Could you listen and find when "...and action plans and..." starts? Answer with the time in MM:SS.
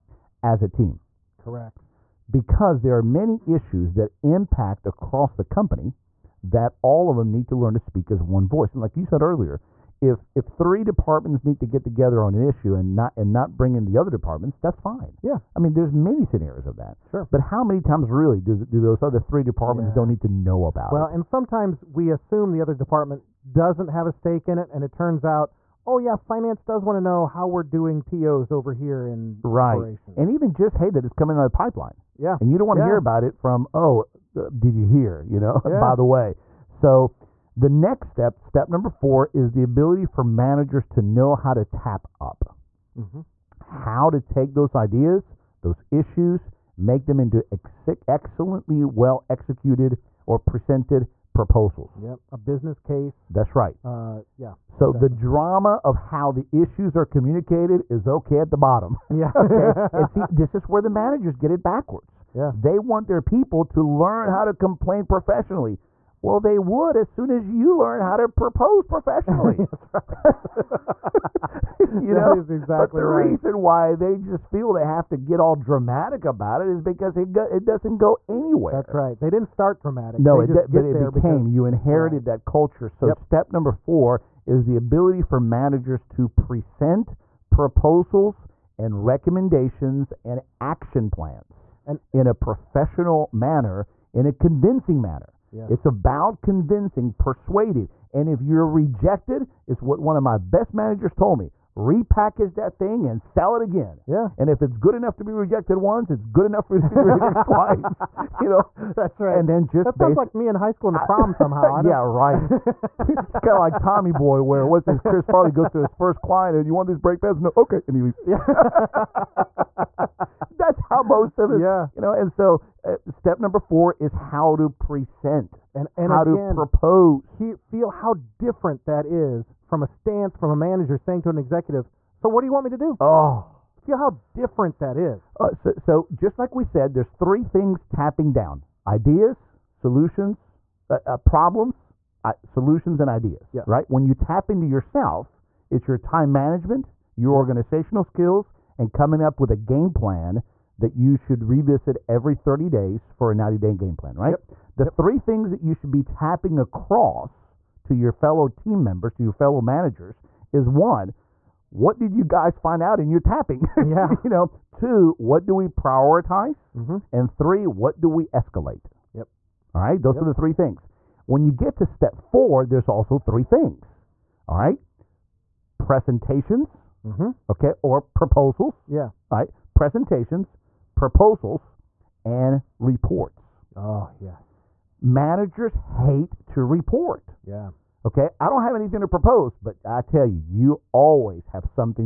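01:30.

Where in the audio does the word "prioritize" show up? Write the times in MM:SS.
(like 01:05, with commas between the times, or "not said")
02:45.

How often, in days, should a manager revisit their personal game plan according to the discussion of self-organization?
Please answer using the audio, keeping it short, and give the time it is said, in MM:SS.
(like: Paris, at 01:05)
30, at 02:32.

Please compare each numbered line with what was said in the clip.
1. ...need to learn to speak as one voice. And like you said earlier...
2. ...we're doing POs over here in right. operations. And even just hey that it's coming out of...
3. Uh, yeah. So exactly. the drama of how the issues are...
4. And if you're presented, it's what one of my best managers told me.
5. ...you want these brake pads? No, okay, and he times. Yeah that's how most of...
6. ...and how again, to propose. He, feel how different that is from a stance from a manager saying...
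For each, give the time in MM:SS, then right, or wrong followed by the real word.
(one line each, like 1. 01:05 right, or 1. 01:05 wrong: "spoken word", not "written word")
1. 00:07 right
2. 00:27 right
3. 00:53 right
4. 01:38 wrong: "rejected", not "presented"
5. 01:56 wrong: "leaves", not "times"
6. 02:05 right.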